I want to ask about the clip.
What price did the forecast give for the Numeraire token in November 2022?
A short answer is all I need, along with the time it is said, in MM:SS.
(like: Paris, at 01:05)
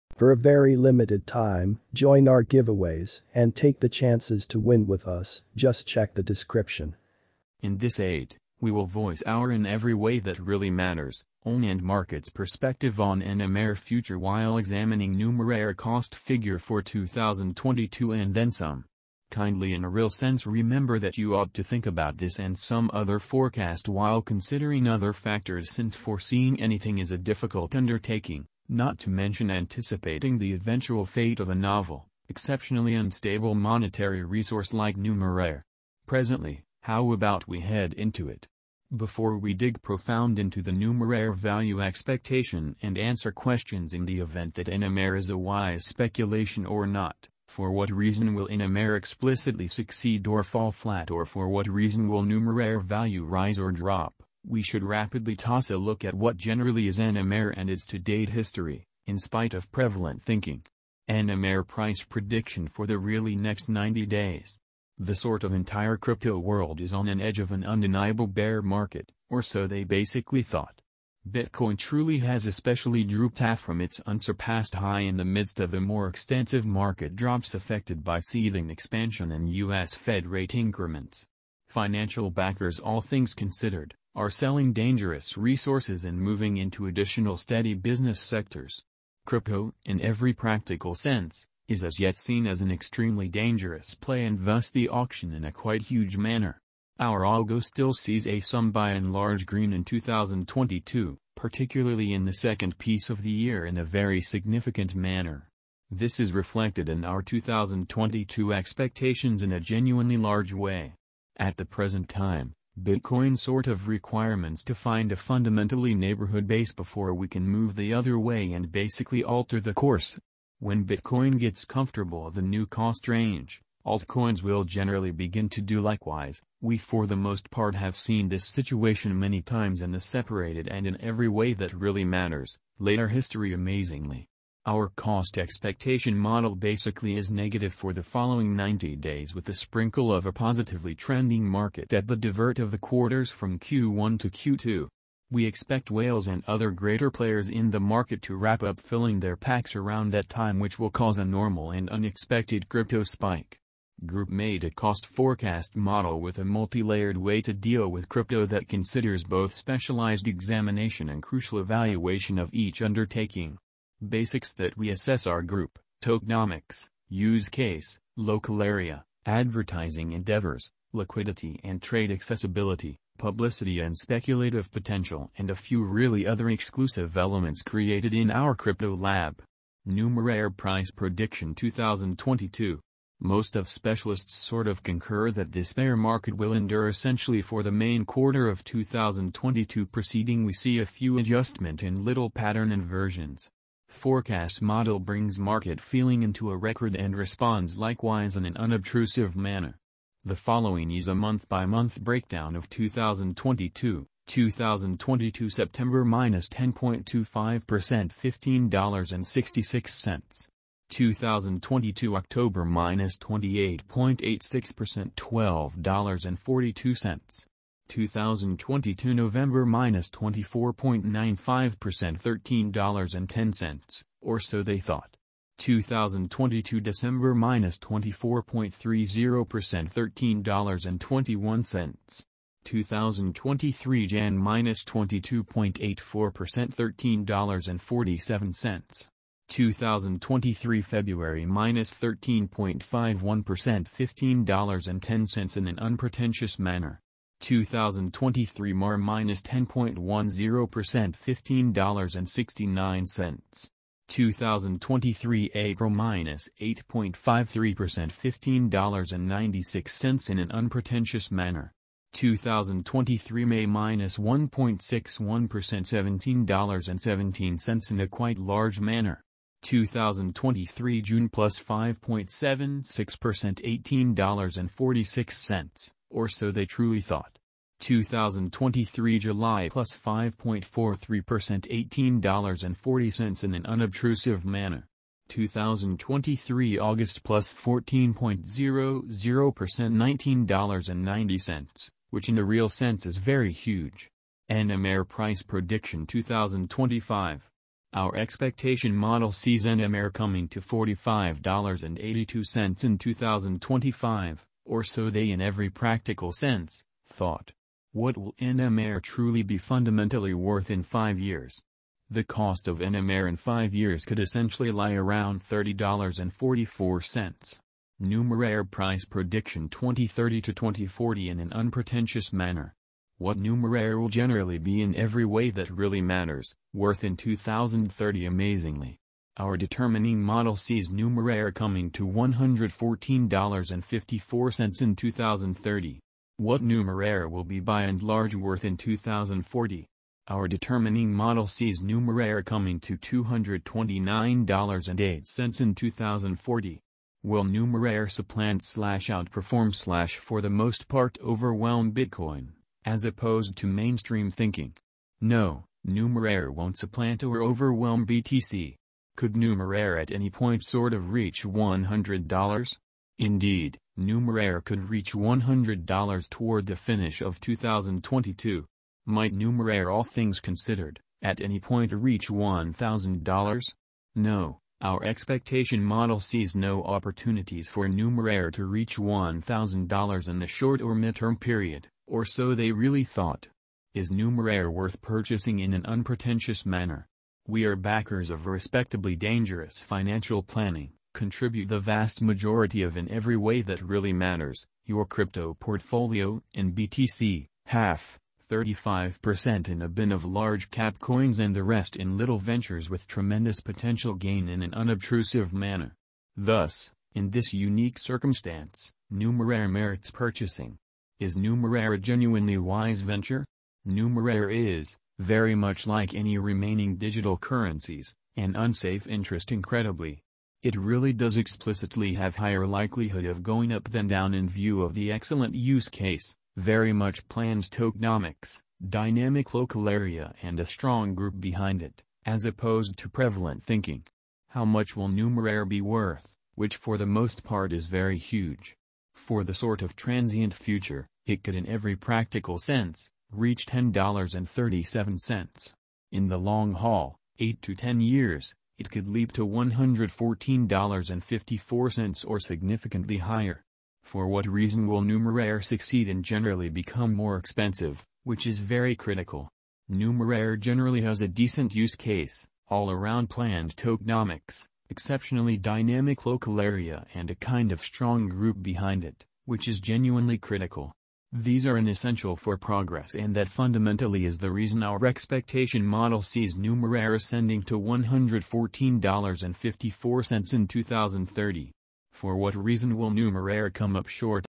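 $13.10, at 03:42.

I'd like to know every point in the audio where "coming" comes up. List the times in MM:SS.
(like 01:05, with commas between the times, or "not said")
05:00, 05:31, 05:42.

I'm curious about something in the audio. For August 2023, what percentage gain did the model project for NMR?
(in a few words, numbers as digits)
14.00%.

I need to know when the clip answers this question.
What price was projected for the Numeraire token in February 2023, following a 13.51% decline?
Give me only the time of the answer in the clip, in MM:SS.
04:04.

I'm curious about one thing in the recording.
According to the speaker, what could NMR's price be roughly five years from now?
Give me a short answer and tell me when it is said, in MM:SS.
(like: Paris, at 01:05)
$30.44, at 05:15.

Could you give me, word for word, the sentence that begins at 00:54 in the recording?
We should rapidly toss a look at what generally is NMR and its to-date history, in spite of prevalent thinking.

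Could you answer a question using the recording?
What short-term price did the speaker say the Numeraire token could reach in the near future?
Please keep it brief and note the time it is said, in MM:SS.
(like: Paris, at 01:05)
$10.37, at 07:23.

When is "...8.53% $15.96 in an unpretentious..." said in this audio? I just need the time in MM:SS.
04:16.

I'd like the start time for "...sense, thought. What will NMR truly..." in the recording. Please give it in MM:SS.
05:06.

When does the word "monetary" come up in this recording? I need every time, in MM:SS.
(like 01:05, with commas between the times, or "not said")
00:33.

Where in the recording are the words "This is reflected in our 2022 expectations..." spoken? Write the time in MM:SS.
01:45.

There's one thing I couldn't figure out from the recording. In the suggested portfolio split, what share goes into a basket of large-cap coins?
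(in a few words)
35%.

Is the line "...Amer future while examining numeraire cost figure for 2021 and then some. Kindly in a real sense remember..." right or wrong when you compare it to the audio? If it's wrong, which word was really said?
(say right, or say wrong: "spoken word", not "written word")
wrong: "2022", not "2021".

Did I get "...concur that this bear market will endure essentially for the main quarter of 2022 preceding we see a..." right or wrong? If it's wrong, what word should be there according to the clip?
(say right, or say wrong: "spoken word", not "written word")
right.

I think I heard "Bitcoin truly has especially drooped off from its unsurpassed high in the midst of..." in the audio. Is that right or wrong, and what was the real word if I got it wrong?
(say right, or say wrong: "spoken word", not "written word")
right.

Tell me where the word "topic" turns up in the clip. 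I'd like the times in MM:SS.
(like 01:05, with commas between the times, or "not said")
not said.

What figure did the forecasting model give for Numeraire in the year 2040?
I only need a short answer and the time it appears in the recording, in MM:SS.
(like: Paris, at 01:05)
$229.08, at 05:42.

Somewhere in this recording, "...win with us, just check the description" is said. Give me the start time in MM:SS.
00:04.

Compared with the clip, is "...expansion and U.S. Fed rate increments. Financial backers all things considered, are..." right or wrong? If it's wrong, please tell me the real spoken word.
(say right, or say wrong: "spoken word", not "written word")
right.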